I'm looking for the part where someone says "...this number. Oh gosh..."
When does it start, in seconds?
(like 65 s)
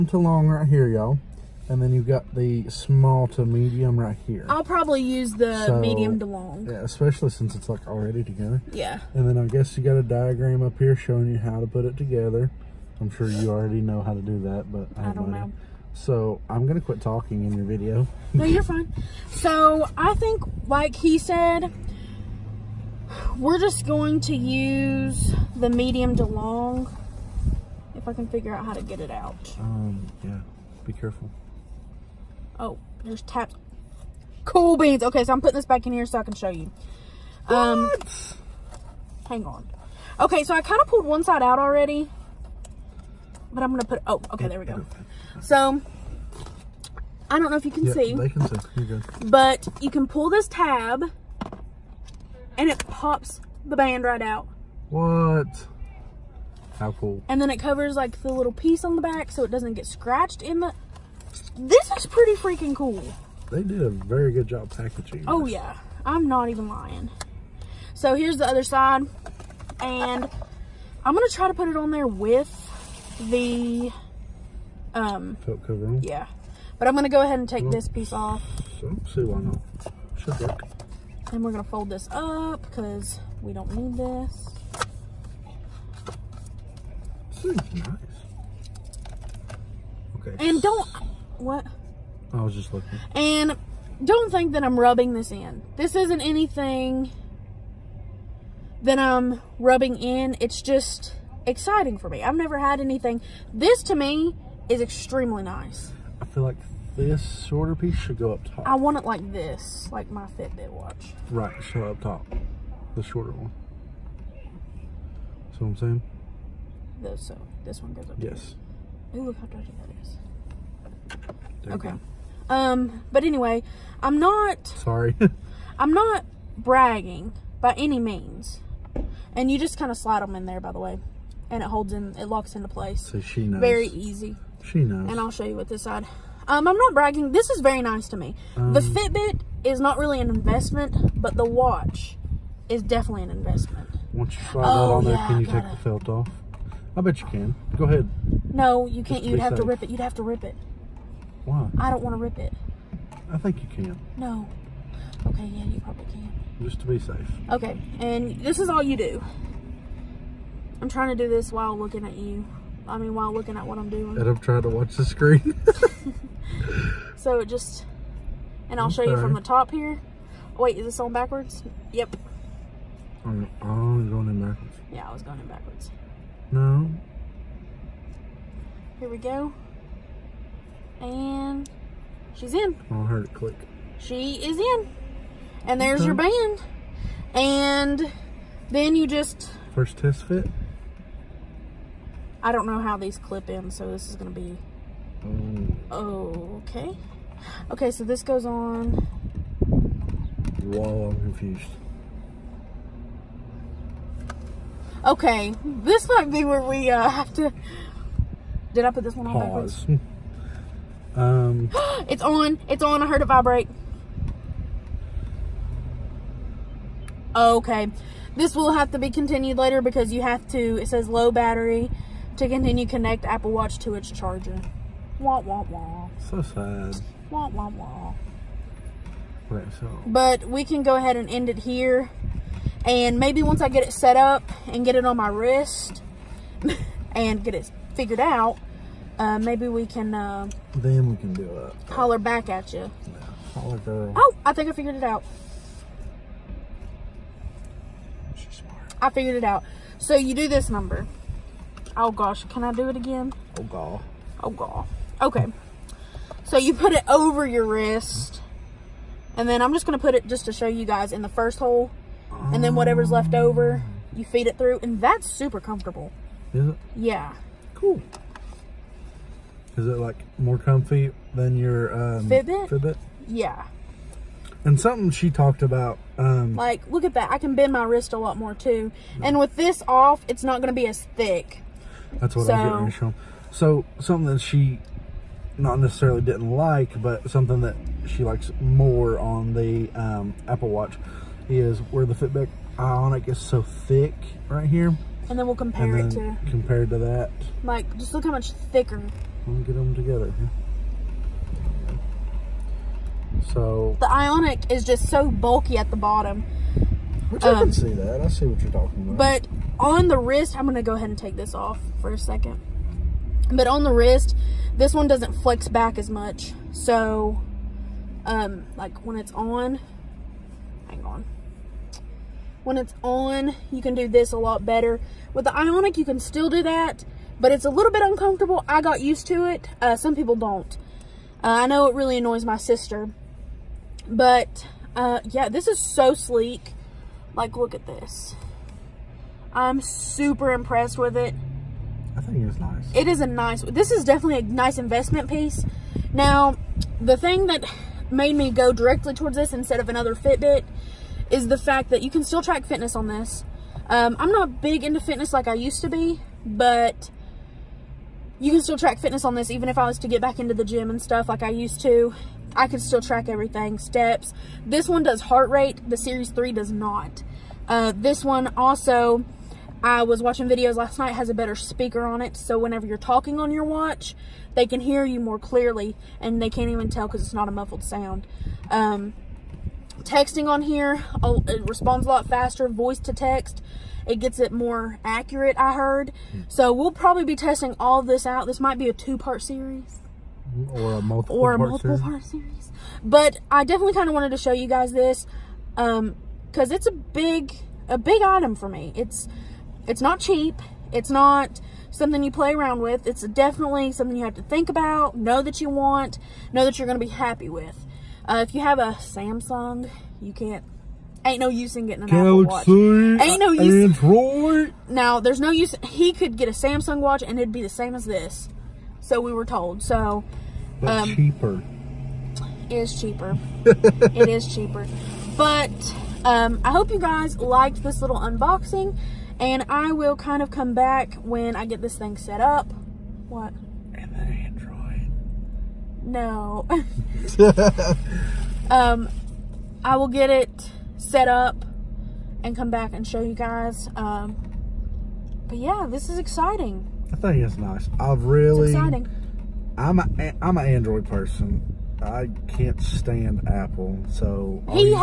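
250 s.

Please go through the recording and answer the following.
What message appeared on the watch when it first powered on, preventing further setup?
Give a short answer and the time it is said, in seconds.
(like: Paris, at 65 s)
low battery, at 221 s.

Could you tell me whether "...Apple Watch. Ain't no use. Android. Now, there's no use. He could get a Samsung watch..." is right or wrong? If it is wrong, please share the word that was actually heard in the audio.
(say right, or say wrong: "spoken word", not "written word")
right.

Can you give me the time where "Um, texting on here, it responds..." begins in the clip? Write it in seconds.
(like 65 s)
378 s.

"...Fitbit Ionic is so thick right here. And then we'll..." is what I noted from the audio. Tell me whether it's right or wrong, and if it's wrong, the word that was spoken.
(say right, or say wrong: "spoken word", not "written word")
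right.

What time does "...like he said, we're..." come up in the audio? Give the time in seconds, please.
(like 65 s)
20 s.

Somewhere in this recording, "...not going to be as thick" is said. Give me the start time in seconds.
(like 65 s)
280 s.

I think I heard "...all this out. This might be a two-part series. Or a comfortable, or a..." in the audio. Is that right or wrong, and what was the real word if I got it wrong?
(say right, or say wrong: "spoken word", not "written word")
wrong: "multiple", not "comfortable".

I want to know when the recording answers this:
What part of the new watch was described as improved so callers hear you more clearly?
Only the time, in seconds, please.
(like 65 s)
371 s.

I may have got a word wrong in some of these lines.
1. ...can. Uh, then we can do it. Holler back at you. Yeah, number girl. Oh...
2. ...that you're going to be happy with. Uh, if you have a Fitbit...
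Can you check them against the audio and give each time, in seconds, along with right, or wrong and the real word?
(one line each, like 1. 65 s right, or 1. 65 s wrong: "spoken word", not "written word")
1. 239 s wrong: "holler", not "number"
2. 406 s wrong: "Samsung", not "Fitbit".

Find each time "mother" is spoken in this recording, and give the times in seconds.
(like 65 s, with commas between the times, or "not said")
not said.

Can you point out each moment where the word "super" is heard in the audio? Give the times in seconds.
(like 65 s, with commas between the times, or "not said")
265 s, 339 s.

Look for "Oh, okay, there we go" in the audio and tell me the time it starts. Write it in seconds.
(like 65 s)
44 s.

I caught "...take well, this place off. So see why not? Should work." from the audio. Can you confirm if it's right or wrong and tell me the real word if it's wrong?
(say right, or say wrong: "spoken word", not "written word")
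wrong: "piece", not "place".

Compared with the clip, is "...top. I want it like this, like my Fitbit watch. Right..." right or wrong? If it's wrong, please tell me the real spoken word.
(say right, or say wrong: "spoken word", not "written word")
right.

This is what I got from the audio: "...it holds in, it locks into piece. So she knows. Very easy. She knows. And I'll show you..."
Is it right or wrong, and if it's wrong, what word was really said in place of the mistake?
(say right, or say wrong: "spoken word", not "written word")
wrong: "place", not "piece".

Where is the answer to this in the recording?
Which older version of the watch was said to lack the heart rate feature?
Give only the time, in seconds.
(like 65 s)
365 s.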